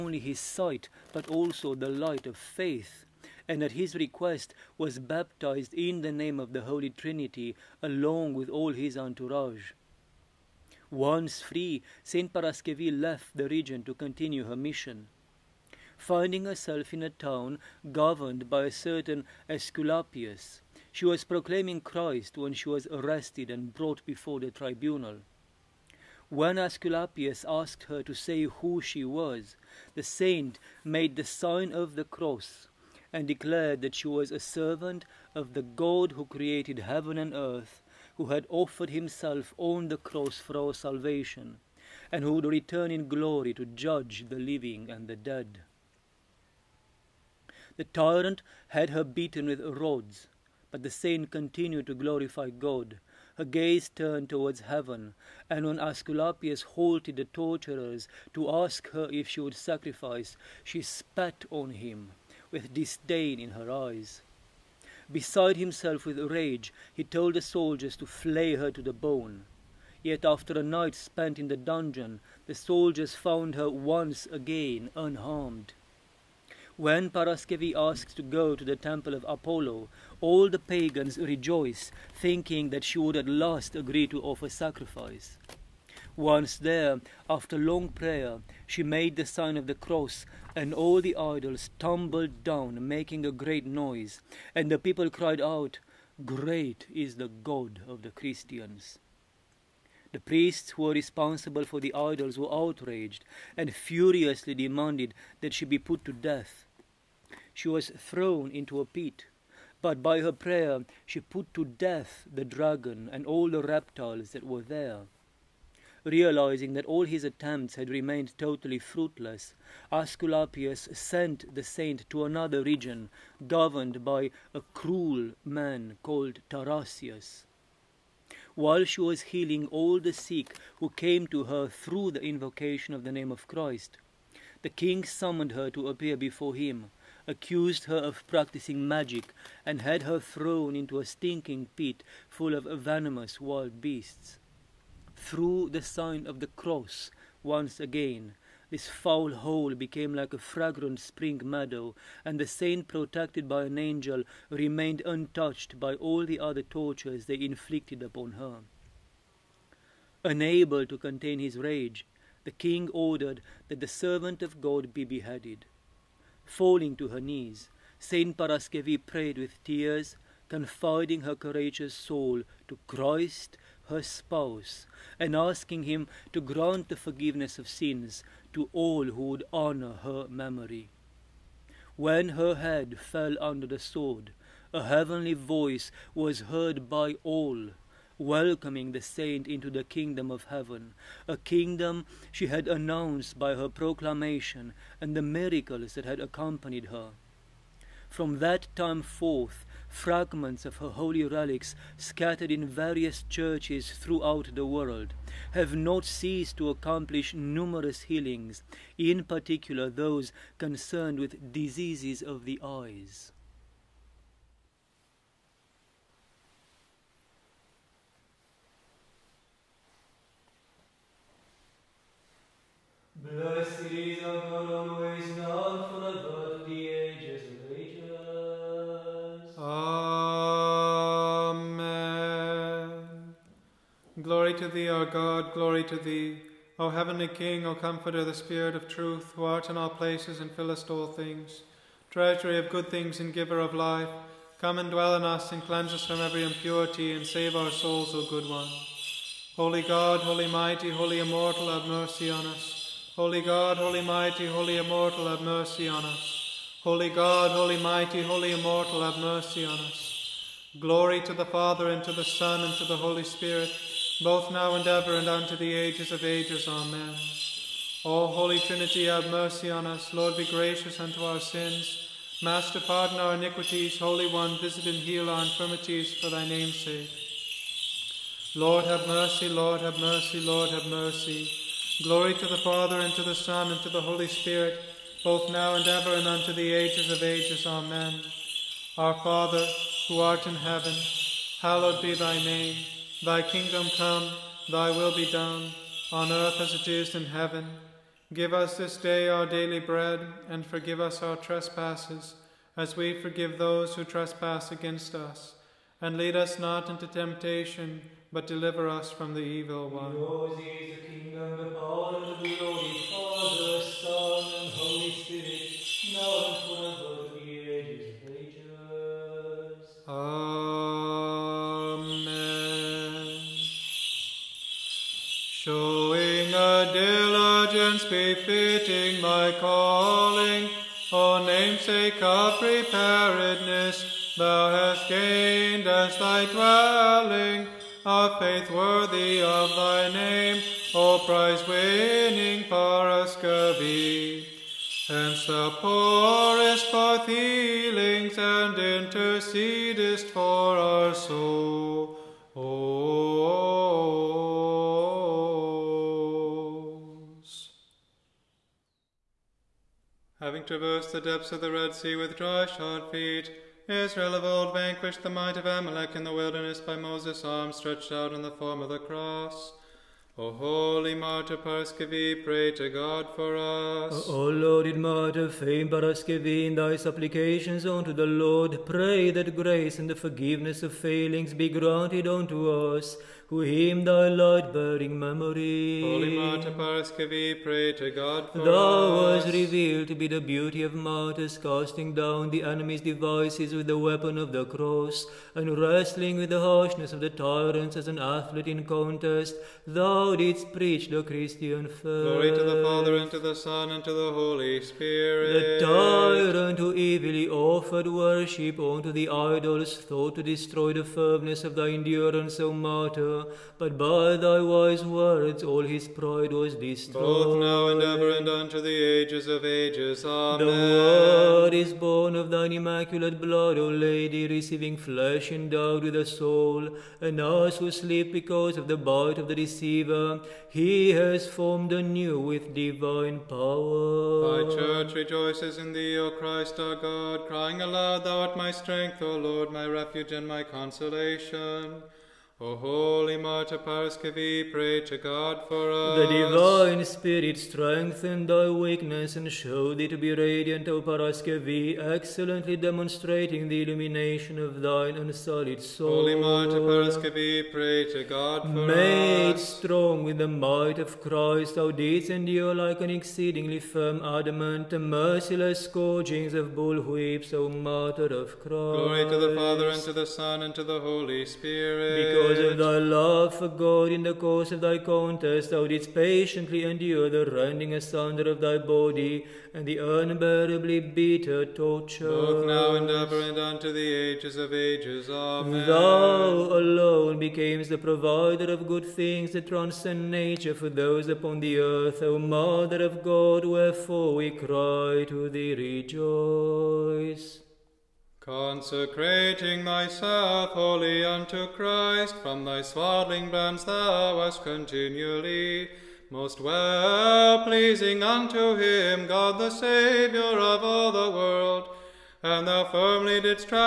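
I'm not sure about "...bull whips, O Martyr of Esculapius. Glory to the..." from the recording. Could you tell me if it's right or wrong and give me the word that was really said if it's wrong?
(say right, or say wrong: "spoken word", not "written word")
wrong: "Christ", not "Esculapius".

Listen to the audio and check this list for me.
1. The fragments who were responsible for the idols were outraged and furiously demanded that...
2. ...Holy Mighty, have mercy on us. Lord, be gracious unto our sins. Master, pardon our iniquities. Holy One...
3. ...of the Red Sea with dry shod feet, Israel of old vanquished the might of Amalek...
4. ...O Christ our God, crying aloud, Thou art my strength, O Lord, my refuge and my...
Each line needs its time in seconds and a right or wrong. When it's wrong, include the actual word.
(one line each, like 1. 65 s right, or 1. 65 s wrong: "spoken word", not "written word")
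1. 100 s wrong: "priests", not "fragments"
2. 268 s wrong: "Trinity", not "Mighty"
3. 361 s right
4. 436 s right.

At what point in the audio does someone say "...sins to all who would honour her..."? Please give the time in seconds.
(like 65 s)
177 s.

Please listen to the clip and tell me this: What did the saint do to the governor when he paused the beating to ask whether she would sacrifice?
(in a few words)
spat on him.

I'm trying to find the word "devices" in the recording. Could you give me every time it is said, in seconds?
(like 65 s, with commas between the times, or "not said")
393 s.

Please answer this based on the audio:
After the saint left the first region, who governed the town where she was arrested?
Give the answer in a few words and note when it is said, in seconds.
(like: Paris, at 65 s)
Esculapius, at 19 s.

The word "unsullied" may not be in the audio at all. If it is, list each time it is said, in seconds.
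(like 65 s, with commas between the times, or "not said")
455 s.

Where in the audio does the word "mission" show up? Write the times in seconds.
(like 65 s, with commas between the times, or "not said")
14 s.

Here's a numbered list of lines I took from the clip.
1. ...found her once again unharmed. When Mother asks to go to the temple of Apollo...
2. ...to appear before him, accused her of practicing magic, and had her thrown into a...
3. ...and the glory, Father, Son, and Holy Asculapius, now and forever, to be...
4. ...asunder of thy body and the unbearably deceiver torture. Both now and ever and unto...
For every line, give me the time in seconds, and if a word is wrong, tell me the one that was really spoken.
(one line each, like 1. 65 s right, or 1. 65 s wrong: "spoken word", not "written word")
1. 73 s wrong: "Paraskevi", not "Mother"
2. 135 s right
3. 312 s wrong: "Spirit", not "Asculapius"
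4. 477 s wrong: "bitter", not "deceiver".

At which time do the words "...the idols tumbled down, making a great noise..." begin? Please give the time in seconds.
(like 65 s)
90 s.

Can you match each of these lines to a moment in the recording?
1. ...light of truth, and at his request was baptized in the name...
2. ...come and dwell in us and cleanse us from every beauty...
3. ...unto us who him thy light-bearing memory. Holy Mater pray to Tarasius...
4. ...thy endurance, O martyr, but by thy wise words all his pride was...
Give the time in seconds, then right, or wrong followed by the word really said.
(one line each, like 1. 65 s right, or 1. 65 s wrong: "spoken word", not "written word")
1. 1 s wrong: "faith", not "truth"
2. 244 s wrong: "impurity", not "beauty"
3. 382 s wrong: "God", not "Tarasius"
4. 411 s right.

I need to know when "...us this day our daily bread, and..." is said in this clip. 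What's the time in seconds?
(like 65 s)
298 s.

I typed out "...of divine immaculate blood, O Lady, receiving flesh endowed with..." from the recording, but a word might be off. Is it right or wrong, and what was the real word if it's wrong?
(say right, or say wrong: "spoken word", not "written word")
wrong: "thine", not "divine".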